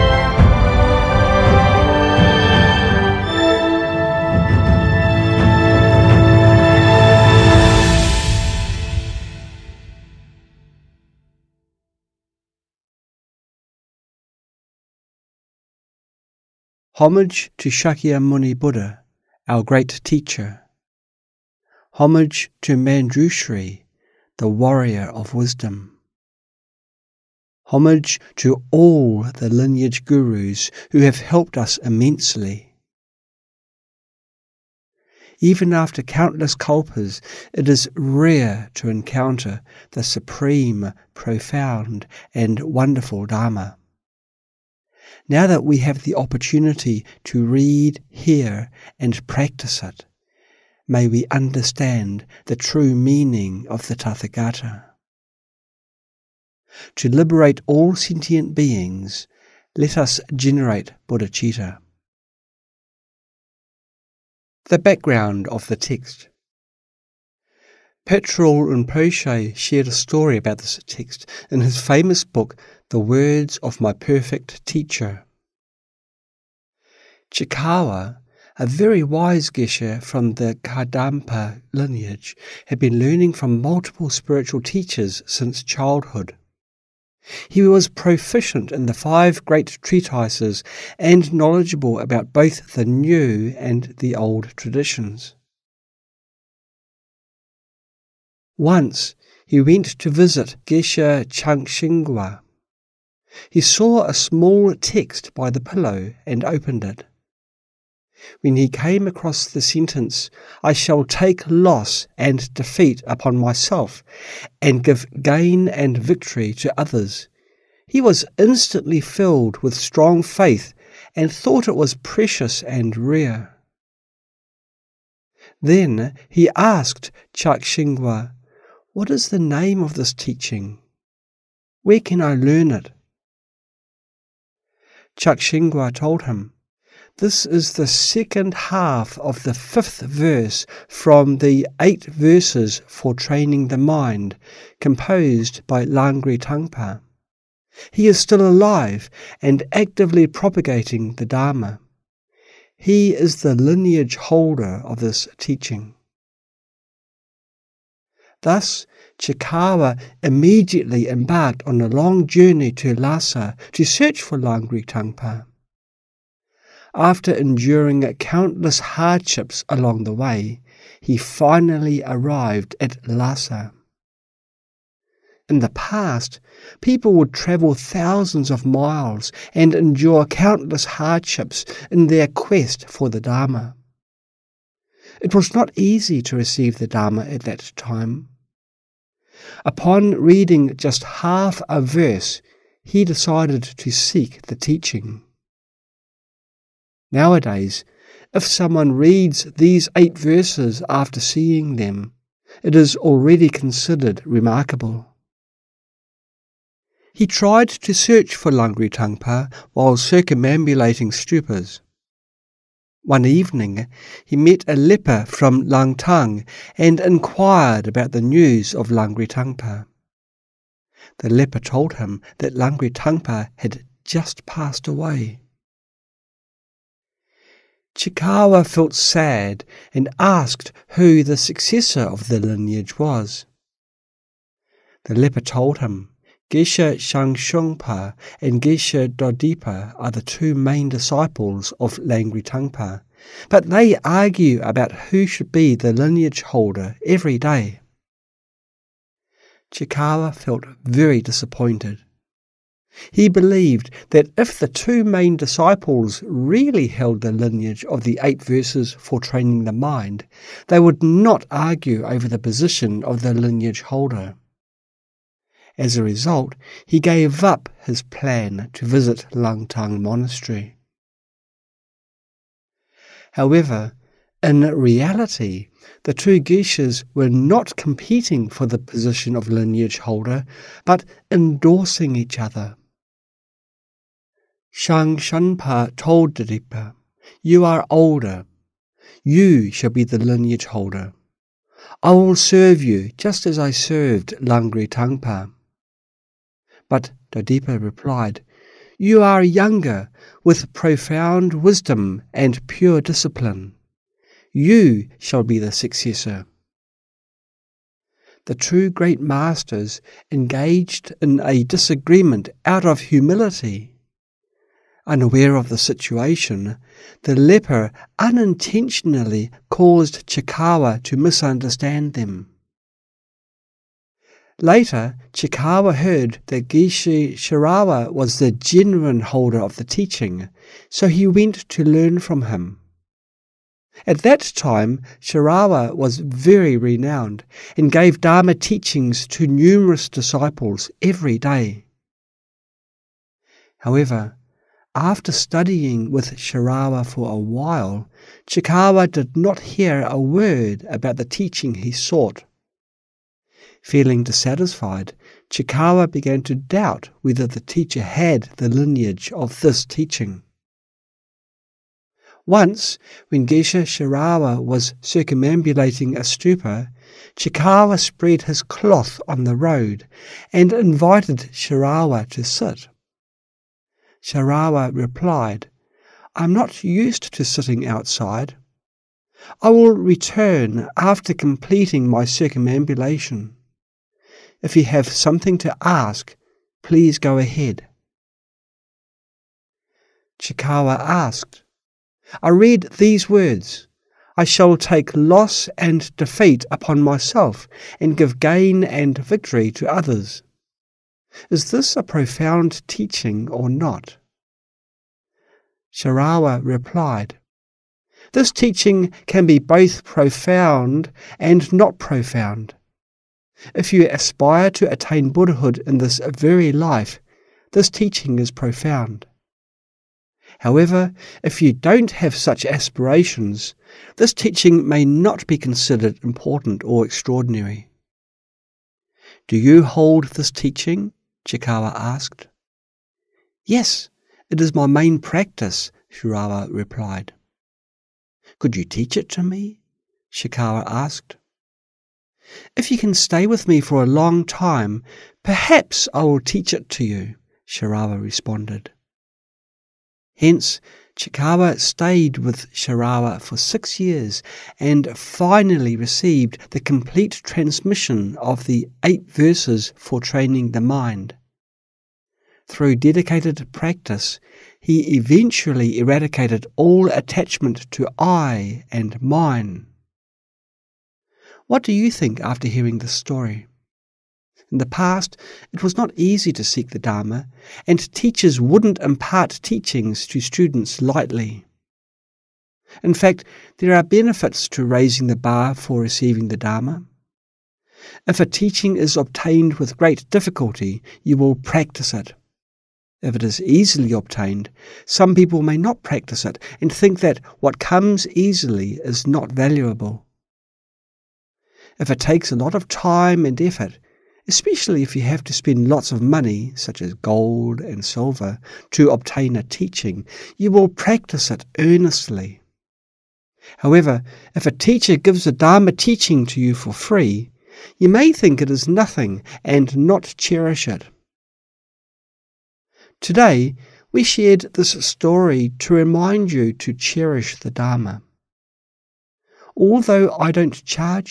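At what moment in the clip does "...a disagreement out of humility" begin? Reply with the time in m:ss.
5:11.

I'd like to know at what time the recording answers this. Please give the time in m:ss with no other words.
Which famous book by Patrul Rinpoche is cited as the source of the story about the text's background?
1:12.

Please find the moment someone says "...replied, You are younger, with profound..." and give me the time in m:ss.
4:57.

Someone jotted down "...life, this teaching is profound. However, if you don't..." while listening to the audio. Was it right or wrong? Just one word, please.
right.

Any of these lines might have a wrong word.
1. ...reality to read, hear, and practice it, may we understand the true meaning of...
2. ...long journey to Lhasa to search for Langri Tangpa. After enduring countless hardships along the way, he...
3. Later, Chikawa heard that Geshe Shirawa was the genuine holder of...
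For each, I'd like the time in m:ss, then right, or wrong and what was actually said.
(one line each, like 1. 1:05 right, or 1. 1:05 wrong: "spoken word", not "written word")
1. 0:46 wrong: "opportunity", not "reality"
2. 2:41 right
3. 5:24 right.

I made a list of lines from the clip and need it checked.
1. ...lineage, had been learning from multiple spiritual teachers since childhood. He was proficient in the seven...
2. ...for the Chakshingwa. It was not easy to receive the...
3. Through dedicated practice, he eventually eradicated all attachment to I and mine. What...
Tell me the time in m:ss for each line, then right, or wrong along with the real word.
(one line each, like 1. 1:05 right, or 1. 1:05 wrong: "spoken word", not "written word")
1. 1:21 wrong: "five", not "seven"
2. 3:02 wrong: "Dharma", not "Chakshingwa"
3. 7:42 right.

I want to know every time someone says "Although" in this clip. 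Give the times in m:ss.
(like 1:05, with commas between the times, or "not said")
8:49.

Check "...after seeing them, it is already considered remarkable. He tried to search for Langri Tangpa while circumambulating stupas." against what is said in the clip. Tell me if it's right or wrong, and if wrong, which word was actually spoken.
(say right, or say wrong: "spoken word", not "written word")
right.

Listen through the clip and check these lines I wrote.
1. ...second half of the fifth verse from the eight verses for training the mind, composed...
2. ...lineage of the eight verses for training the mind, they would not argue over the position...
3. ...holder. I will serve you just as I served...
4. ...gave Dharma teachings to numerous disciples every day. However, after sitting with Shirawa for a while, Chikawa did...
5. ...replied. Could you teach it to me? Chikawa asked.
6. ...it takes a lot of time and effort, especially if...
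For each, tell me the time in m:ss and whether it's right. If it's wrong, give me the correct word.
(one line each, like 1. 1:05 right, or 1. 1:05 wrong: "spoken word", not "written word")
1. 2:17 right
2. 4:17 right
3. 4:50 right
4. 5:37 wrong: "studying", not "sitting"
5. 7:16 right
6. 8:22 right.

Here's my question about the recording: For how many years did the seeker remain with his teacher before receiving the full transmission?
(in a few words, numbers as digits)
6.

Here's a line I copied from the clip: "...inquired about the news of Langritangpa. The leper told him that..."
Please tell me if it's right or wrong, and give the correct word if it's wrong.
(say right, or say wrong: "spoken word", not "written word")
right.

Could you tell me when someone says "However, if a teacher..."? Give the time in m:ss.
8:33.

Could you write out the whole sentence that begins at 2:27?
He is still alive and actively propagating the Dharma.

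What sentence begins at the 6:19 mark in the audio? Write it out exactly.
I will return after completing my circumambulation.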